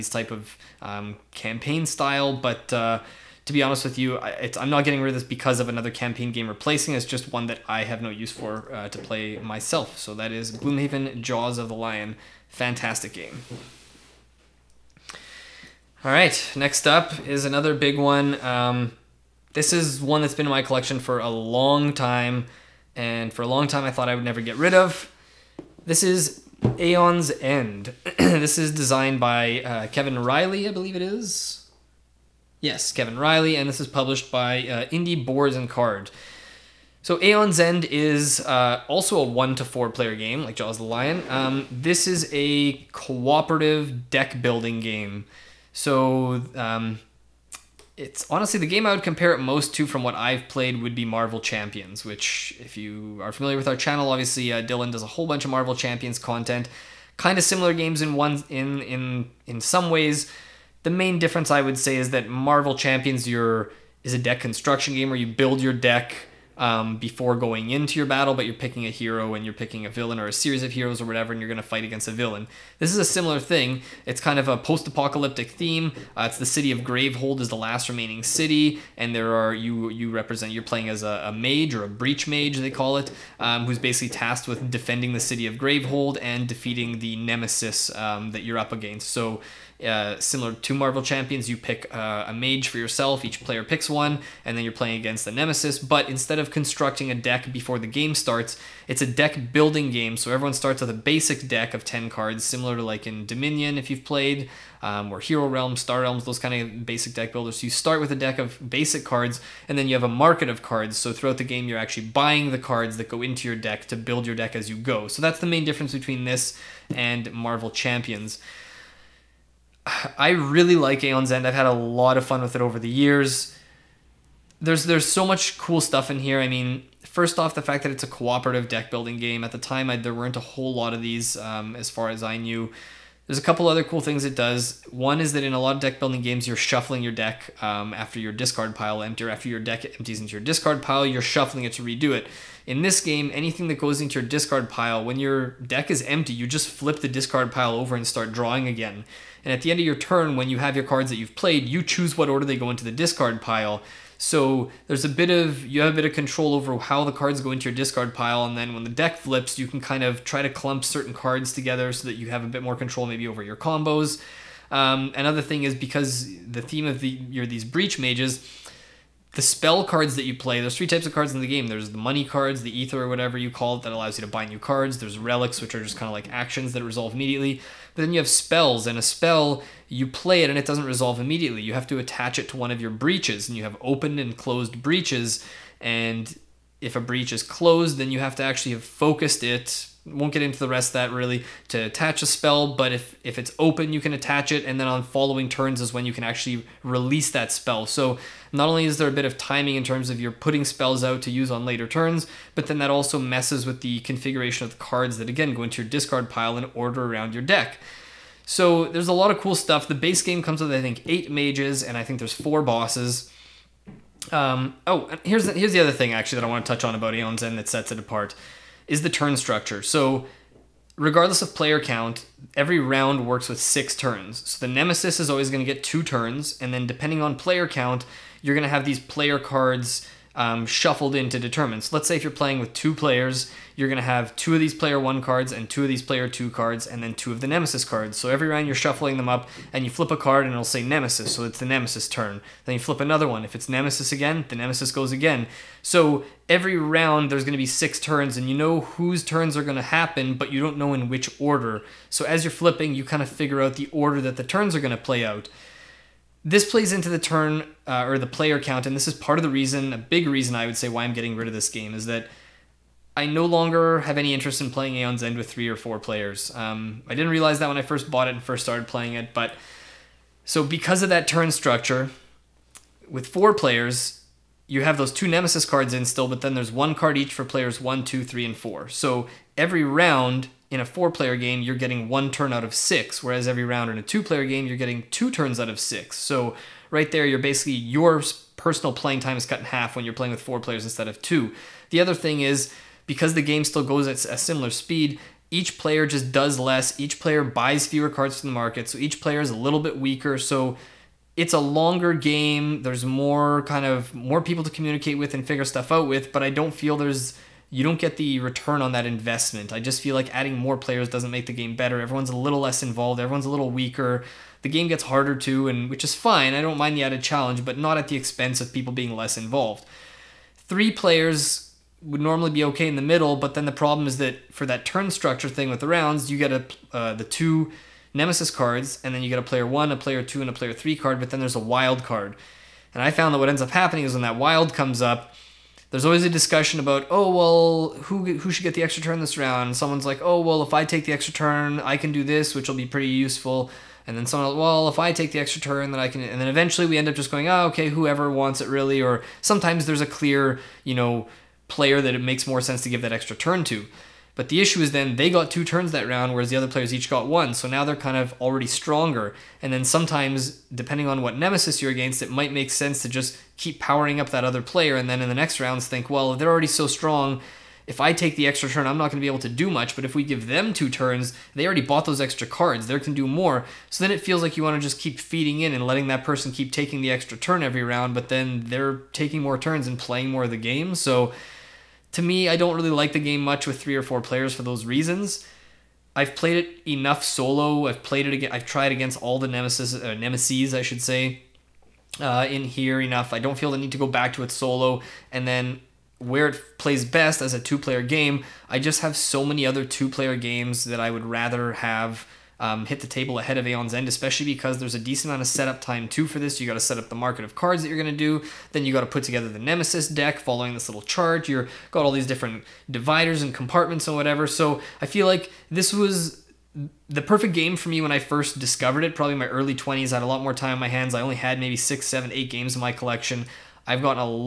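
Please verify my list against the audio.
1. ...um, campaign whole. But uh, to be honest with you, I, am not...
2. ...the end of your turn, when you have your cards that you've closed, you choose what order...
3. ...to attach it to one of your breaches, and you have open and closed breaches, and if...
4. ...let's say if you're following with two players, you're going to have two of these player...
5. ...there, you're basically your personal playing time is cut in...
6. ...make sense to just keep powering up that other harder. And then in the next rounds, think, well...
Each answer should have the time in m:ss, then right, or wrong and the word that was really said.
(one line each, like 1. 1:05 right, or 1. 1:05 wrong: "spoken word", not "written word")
1. 0:00 wrong: "style", not "whole"
2. 2:29 wrong: "played", not "closed"
3. 3:01 right
4. 3:51 wrong: "playing", not "following"
5. 4:47 right
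6. 6:02 wrong: "player", not "harder".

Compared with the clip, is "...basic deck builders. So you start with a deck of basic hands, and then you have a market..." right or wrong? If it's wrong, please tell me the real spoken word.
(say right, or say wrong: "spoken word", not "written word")
wrong: "cards", not "hands".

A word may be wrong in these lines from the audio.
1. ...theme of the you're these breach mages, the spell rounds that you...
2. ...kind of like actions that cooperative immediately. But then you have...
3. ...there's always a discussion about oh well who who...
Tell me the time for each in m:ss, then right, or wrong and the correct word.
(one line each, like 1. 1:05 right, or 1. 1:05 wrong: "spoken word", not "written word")
1. 2:46 wrong: "cards", not "rounds"
2. 2:55 wrong: "resolve", not "cooperative"
3. 5:35 right.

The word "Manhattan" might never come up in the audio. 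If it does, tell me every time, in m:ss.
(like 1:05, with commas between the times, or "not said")
not said.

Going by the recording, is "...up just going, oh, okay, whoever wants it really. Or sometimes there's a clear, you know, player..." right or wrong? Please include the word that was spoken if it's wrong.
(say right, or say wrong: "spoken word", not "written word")
right.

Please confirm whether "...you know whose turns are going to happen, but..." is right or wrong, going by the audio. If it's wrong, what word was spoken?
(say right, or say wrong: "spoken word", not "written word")
right.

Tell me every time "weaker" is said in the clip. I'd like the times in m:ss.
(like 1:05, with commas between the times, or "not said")
4:59, 5:13.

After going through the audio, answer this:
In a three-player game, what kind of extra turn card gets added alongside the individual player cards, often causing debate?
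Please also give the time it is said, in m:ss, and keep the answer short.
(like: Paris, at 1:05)
wild card, at 5:31.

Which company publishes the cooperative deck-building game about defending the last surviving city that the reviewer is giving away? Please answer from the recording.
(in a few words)
Indie Boards and Card.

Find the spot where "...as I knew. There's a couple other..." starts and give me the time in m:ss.
2:12.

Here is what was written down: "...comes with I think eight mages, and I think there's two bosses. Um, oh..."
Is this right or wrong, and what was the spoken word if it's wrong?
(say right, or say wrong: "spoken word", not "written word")
wrong: "four", not "two".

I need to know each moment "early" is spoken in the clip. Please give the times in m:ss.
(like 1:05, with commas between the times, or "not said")
6:59.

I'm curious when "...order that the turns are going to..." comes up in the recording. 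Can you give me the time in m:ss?
4:13.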